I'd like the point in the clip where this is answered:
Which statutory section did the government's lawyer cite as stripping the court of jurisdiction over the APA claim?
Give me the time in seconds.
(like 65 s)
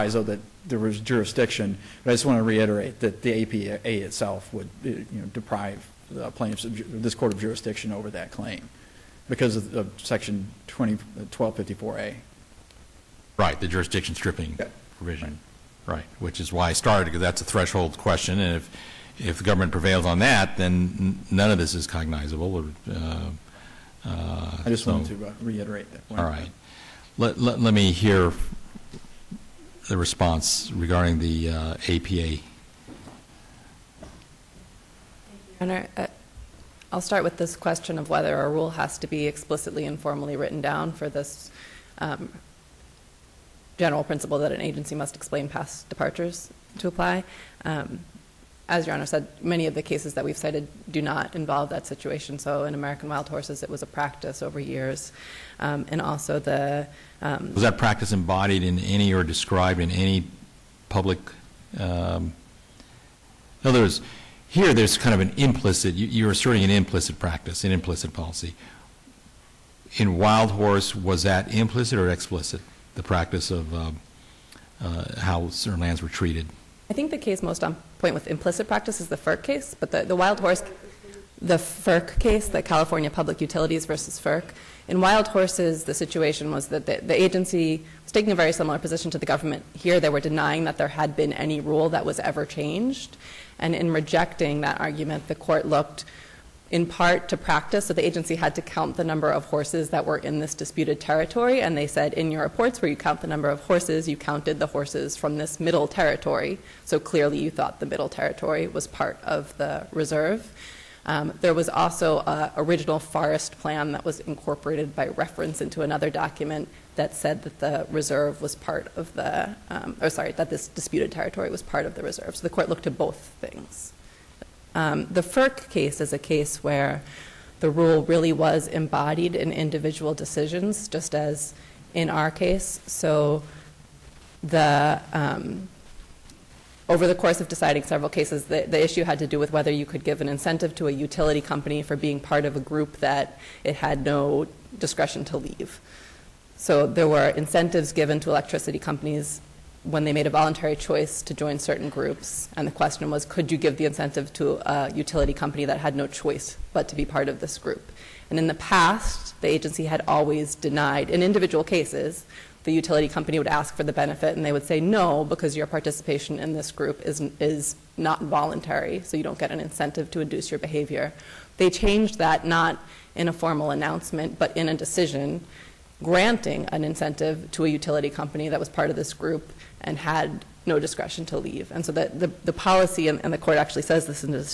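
11 s.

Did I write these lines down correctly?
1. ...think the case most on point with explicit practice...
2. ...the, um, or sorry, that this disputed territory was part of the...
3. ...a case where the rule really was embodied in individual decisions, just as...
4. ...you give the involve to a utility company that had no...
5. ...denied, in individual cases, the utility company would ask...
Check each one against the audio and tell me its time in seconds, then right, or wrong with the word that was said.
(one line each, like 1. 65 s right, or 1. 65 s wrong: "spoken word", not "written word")
1. 76 s wrong: "implicit", not "explicit"
2. 119 s right
3. 126 s right
4. 153 s wrong: "incentive", not "involve"
5. 160 s right.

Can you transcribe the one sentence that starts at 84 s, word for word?
In wild horses, the situation was that the, the agency was taking a very similar position to the government.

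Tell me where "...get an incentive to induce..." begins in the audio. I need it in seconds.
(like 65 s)
169 s.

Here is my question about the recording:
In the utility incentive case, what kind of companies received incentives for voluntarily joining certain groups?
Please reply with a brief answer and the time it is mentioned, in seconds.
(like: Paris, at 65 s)
Electricity companies, at 148 s.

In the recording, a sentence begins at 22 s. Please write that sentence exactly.
Uh, uh, I just so, wanted to uh, reiterate that point.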